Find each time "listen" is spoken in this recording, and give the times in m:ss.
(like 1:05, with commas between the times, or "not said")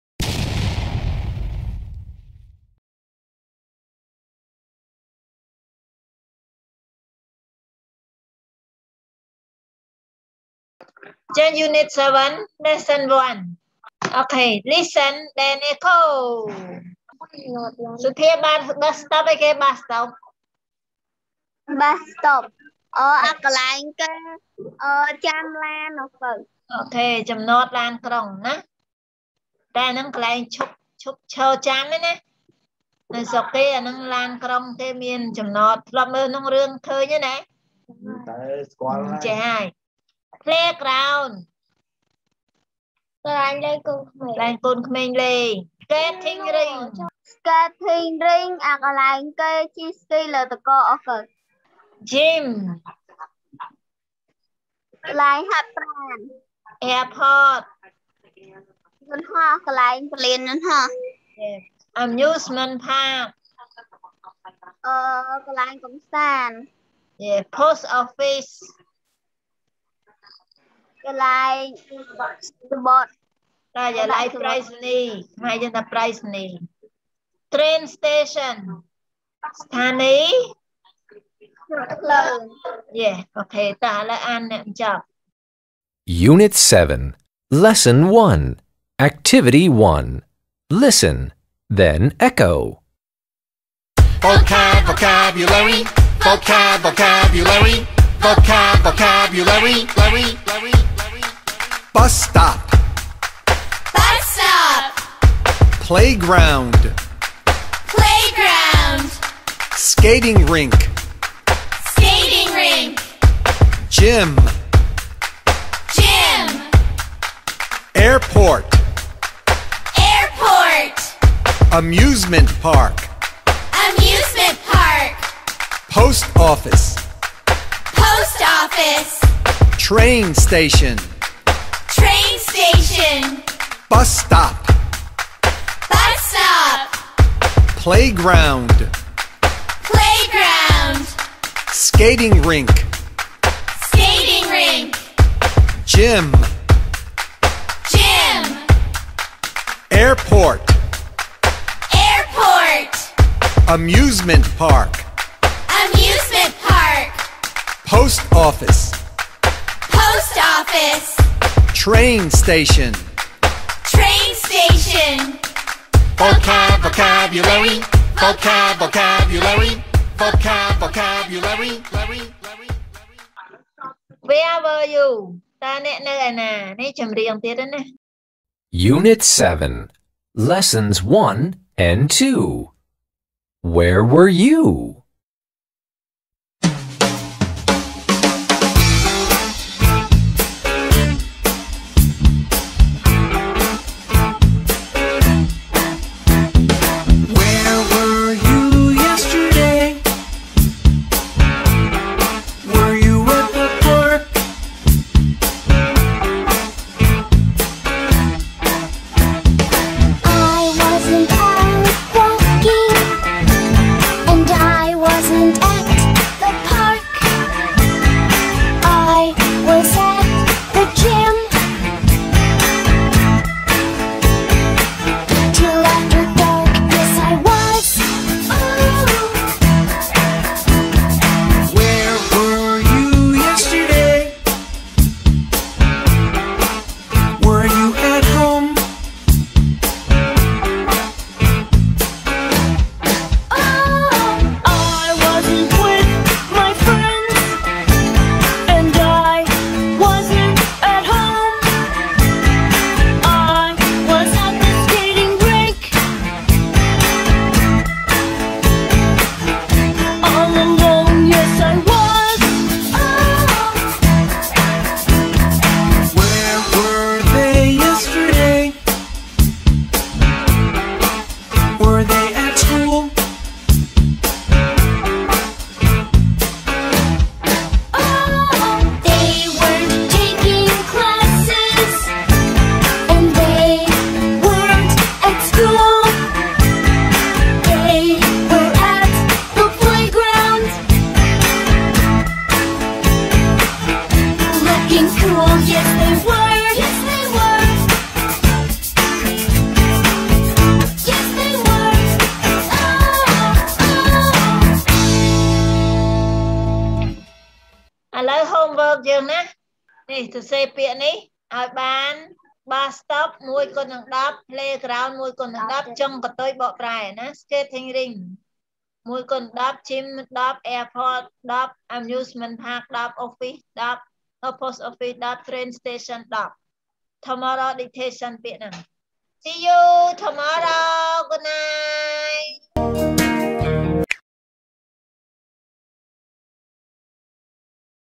0:14, 1:30.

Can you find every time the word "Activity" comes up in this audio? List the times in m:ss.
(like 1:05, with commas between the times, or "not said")
1:29.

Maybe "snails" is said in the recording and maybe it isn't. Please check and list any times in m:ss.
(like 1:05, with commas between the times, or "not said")
not said.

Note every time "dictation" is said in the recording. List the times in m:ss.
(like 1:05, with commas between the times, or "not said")
5:27.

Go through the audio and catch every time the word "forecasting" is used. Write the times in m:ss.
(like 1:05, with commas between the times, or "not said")
not said.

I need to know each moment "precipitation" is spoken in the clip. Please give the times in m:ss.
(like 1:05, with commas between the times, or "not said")
not said.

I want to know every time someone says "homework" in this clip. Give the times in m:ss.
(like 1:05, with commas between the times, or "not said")
5:08.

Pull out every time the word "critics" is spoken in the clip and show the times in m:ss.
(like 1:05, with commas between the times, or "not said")
not said.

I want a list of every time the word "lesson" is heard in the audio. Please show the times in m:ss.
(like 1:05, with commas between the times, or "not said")
0:12, 1:27, 3:00.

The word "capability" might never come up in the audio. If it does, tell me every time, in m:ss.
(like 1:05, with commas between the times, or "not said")
not said.